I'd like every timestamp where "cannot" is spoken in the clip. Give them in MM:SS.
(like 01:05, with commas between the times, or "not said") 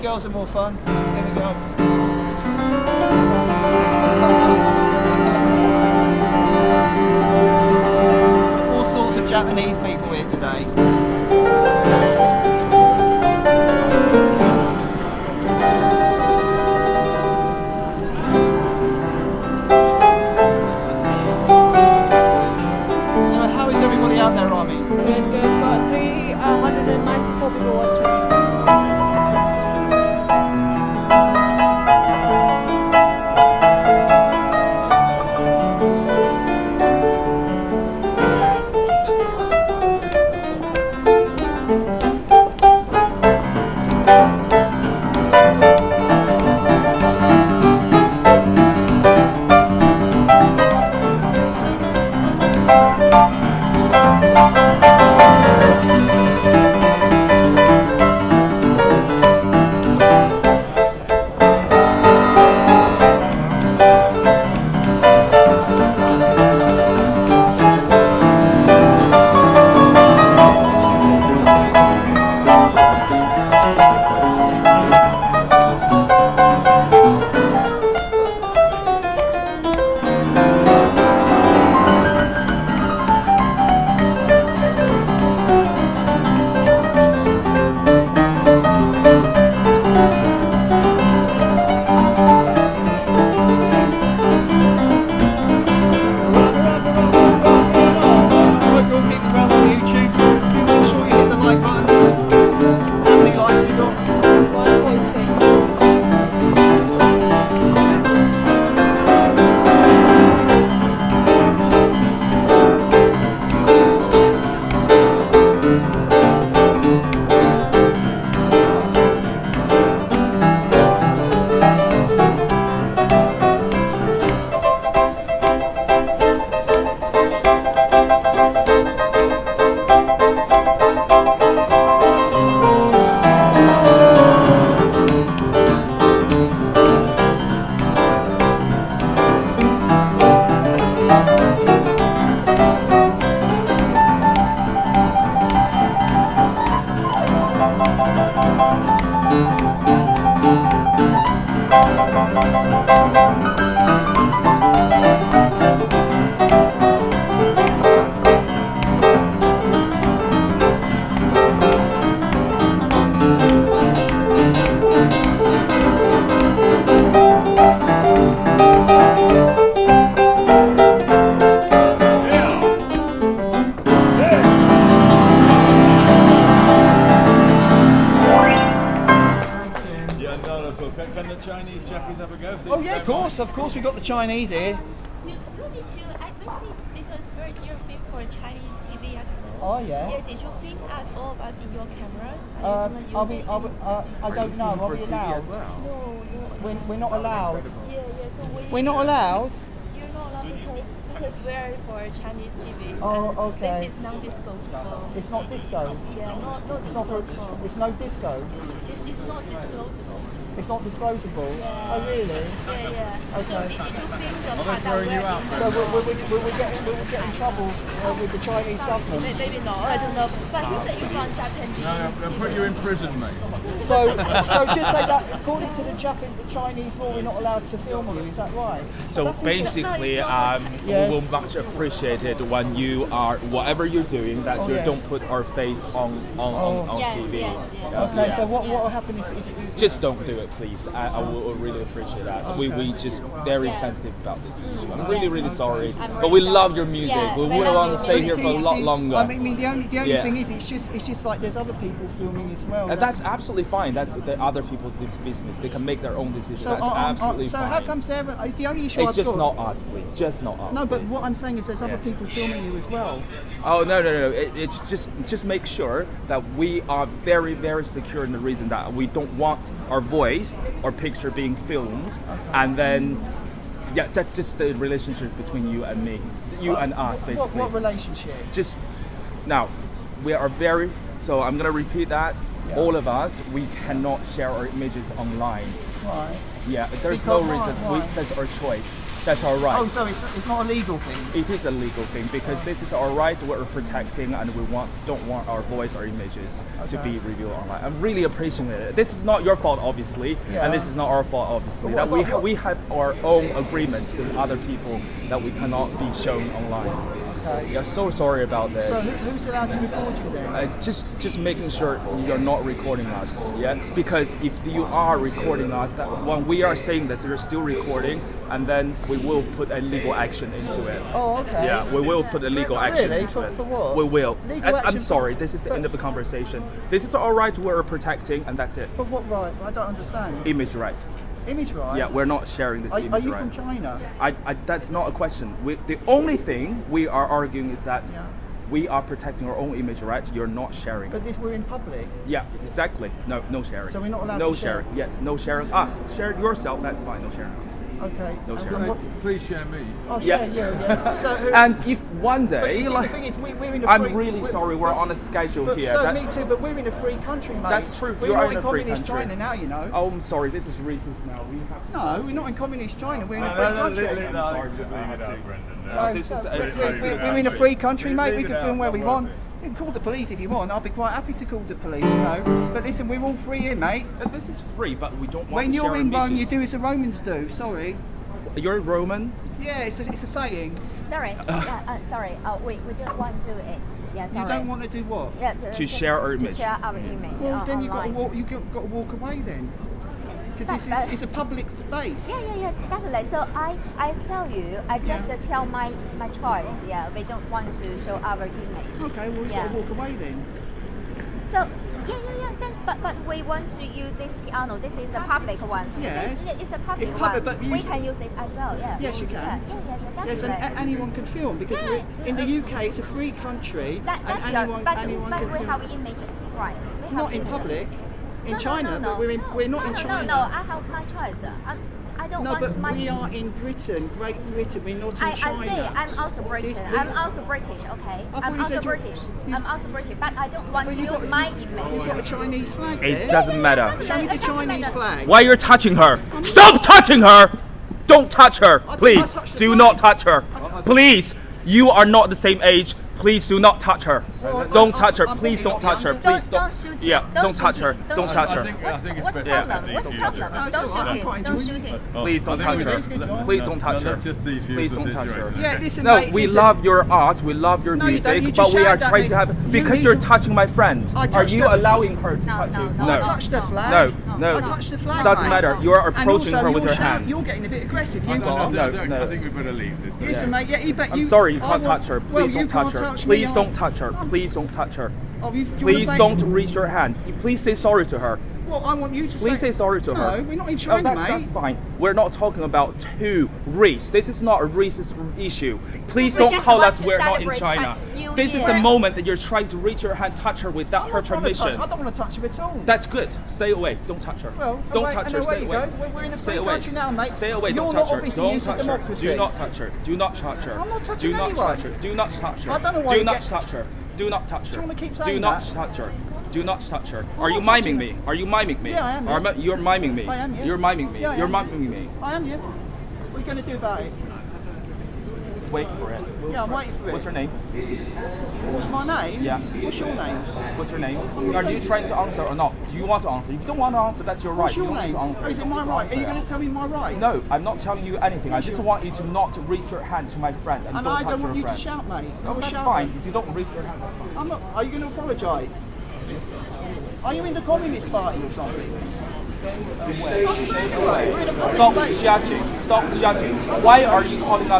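04:43, 05:05.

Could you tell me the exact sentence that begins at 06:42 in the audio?
Then, but, but we want to use this piano.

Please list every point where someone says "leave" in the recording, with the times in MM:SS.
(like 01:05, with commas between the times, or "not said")
06:04, 07:49.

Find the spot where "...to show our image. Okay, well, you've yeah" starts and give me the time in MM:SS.
06:37.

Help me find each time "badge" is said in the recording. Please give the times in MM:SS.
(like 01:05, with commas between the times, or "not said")
not said.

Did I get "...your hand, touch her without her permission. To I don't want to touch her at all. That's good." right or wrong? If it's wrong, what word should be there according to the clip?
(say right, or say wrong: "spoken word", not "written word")
right.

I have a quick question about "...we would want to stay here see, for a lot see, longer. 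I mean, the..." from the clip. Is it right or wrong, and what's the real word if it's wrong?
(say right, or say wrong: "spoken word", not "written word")
right.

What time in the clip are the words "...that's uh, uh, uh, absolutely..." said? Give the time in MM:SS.
04:16.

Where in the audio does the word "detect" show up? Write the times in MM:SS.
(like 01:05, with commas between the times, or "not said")
not said.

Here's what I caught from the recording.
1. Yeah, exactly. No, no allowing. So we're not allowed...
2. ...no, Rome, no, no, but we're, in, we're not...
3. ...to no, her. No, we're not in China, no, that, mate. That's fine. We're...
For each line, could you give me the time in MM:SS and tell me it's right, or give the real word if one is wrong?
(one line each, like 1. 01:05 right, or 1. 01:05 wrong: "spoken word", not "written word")
1. 05:42 wrong: "sharing", not "allowing"
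2. 06:58 wrong: "China", not "Rome"
3. 08:00 right.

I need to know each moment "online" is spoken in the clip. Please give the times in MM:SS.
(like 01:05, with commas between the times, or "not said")
04:45, 04:57, 05:06.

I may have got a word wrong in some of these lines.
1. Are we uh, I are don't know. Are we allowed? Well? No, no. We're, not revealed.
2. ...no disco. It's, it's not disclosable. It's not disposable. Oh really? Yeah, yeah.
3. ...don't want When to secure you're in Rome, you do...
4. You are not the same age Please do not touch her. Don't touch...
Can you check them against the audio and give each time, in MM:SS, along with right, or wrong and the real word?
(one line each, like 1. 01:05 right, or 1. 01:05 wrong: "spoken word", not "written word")
1. 03:13 wrong: "allowed", not "revealed"
2. 03:27 right
3. 06:15 wrong: "share", not "secure"
4. 07:21 right.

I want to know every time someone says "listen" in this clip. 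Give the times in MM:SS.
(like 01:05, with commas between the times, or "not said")
06:12, 07:50.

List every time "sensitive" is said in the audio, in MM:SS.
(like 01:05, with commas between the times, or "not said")
04:03.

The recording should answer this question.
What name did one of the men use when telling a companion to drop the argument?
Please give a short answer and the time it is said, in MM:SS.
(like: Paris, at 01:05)
Brendan, at 06:06.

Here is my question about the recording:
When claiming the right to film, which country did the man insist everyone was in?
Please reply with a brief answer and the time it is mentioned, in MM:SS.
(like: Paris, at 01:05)
Great Britain, at 07:04.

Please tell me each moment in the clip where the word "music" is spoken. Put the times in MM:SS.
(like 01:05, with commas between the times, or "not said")
04:06, 07:37.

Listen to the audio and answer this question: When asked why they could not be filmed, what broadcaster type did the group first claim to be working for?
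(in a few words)
Chinese TV.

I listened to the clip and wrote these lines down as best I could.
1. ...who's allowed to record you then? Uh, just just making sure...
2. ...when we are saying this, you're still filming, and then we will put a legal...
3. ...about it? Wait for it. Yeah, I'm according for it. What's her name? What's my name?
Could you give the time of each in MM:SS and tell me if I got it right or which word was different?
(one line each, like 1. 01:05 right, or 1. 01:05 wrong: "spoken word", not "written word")
1. 05:09 right
2. 05:16 wrong: "recording", not "filming"
3. 08:33 wrong: "waiting", not "according".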